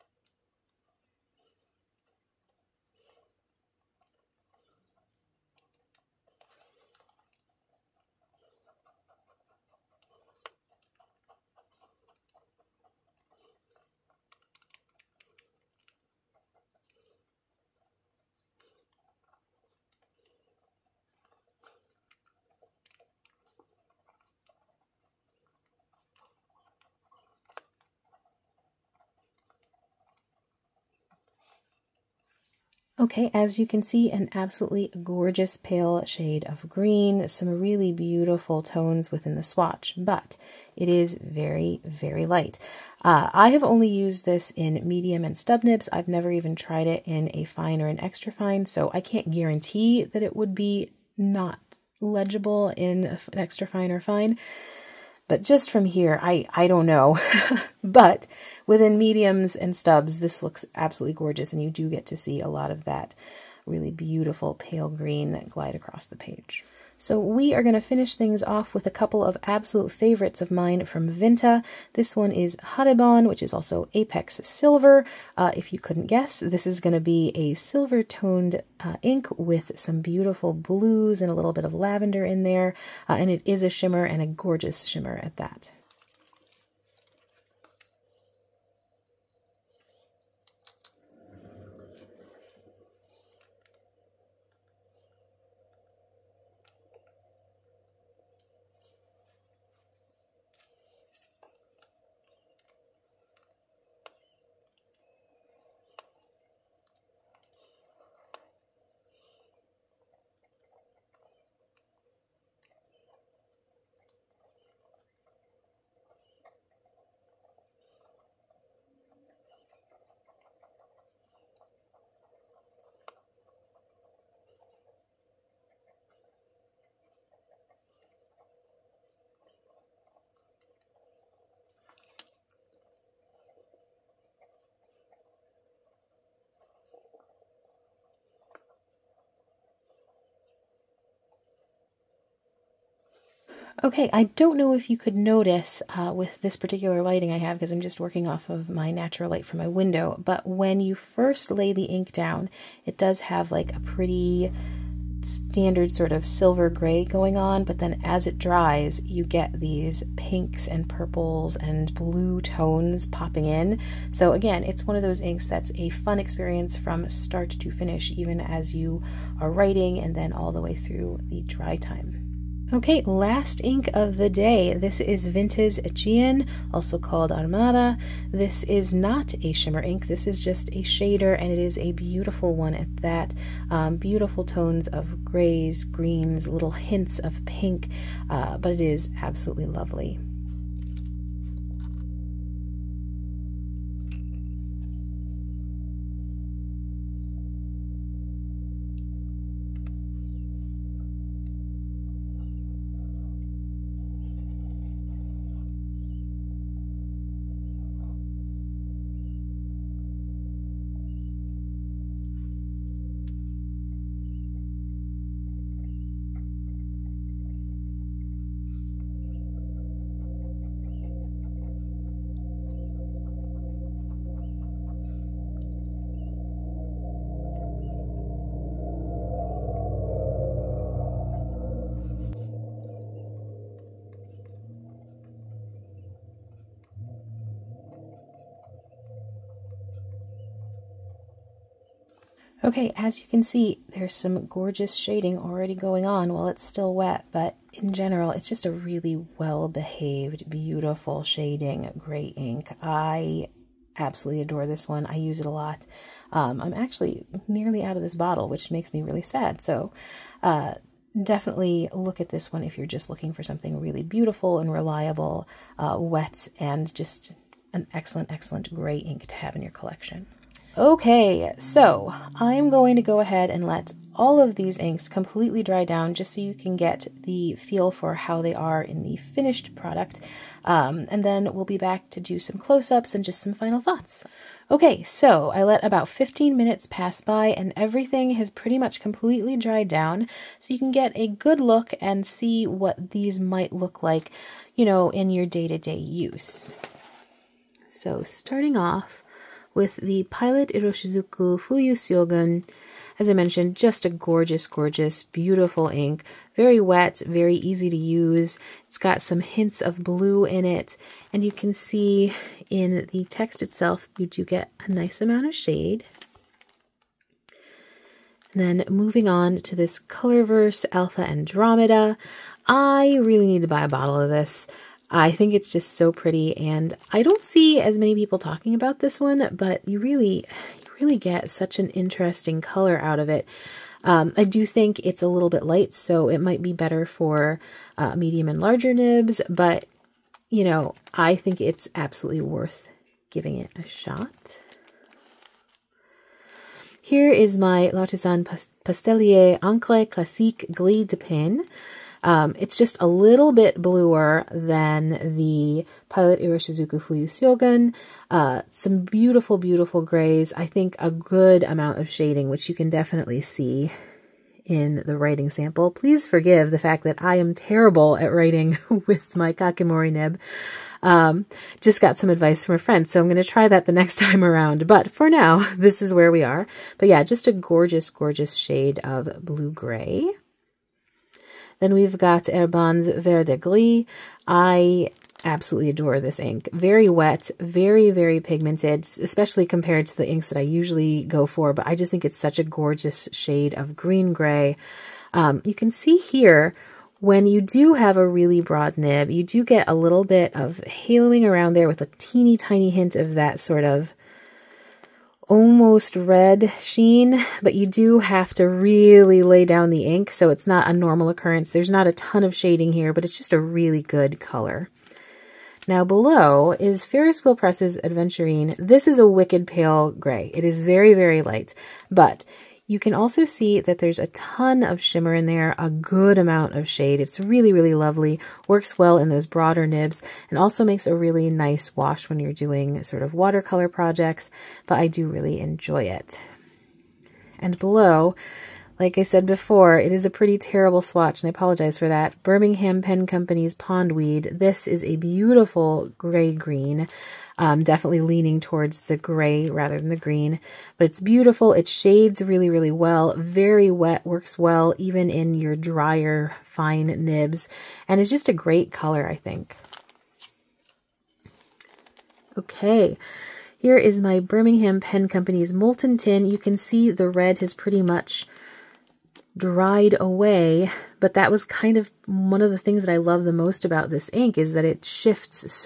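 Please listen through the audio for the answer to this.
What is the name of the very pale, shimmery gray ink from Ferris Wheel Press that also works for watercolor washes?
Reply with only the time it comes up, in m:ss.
6:58.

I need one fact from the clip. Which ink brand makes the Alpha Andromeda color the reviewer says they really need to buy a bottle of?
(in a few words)
Colorverse.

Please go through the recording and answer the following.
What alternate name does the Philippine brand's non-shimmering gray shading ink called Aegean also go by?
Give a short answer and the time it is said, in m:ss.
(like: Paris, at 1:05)
Armada, at 2:57.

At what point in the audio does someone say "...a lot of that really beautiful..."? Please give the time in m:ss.
1:02.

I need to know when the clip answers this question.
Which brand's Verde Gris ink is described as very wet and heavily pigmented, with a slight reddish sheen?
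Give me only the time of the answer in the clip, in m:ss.
6:22.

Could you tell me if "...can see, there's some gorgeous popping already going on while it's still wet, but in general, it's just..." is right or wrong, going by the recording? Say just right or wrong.
wrong.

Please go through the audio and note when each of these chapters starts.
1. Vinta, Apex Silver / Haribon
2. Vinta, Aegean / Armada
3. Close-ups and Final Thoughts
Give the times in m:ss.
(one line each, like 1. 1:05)
1. 1:06
2. 2:52
3. 4:30.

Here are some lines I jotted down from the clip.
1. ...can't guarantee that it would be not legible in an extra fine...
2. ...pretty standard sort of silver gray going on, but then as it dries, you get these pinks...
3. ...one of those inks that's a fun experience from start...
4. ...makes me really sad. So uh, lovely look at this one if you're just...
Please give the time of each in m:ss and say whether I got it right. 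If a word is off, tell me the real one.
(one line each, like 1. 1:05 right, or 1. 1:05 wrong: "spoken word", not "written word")
1. 0:49 right
2. 2:33 right
3. 2:44 right
4. 4:18 wrong: "definitely", not "lovely".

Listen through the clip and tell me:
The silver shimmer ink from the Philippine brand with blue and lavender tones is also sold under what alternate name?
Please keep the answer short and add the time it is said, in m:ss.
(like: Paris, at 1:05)
Apex Silver, at 1:13.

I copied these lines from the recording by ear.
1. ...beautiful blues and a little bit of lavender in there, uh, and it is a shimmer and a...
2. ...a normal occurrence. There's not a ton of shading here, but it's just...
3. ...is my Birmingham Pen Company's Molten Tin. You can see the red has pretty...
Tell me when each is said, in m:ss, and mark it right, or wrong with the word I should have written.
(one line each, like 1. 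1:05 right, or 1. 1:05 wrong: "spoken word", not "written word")
1. 1:20 right
2. 6:50 right
3. 7:43 right.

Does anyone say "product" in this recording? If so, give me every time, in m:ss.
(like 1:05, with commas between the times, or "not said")
4:39.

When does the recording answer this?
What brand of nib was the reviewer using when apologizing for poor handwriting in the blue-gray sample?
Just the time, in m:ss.
6:09.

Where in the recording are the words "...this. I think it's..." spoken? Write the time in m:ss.
5:24.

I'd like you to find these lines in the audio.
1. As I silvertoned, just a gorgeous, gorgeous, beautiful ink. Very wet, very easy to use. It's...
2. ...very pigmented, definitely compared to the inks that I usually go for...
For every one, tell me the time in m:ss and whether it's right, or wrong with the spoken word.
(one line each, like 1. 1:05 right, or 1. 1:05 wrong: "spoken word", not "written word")
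1. 5:03 wrong: "mentioned", not "silvertoned"
2. 6:28 wrong: "especially", not "definitely".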